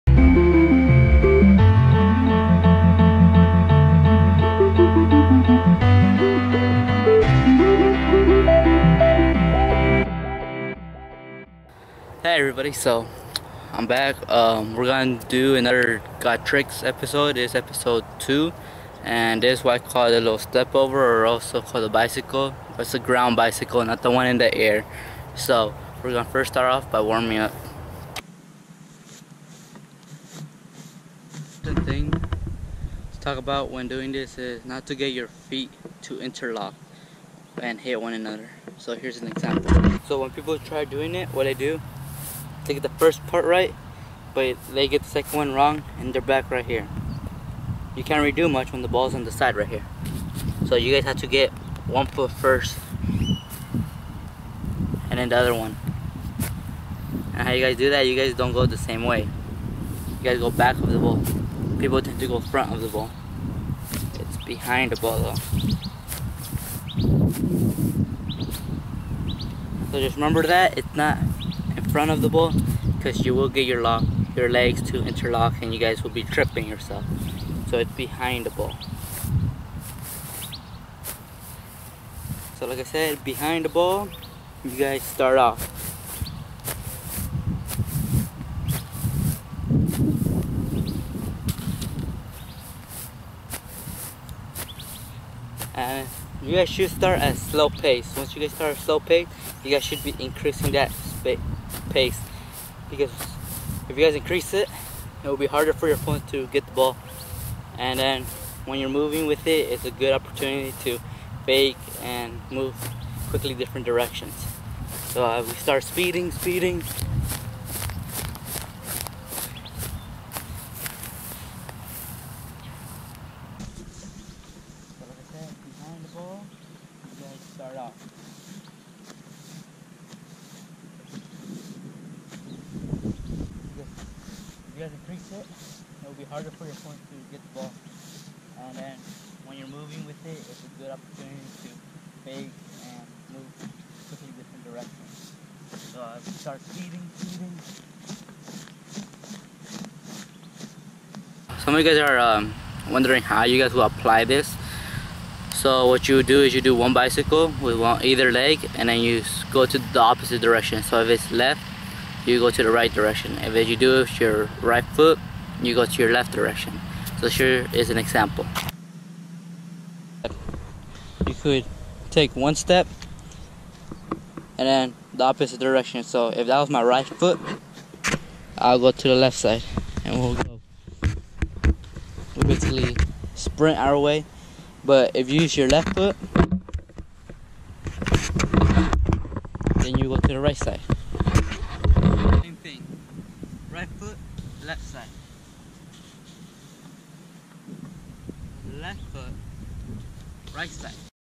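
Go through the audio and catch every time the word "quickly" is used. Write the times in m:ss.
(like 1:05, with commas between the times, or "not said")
1:53, 2:24.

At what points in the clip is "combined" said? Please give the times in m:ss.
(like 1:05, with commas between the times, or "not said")
not said.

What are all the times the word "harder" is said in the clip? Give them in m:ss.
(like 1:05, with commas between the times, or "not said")
1:45, 2:16.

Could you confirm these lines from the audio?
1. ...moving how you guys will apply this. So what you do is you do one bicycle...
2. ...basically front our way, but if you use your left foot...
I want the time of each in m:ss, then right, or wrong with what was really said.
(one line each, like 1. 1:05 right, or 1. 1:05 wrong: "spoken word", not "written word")
1. 2:32 wrong: "wondering", not "moving"
2. 3:02 wrong: "sprint", not "front".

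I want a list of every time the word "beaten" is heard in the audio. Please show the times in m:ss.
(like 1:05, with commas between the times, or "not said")
not said.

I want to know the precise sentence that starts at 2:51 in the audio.
You could take one step and then the opposite direction.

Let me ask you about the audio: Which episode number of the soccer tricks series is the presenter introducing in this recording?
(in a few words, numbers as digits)
2.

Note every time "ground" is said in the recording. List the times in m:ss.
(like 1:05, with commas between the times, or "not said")
0:22.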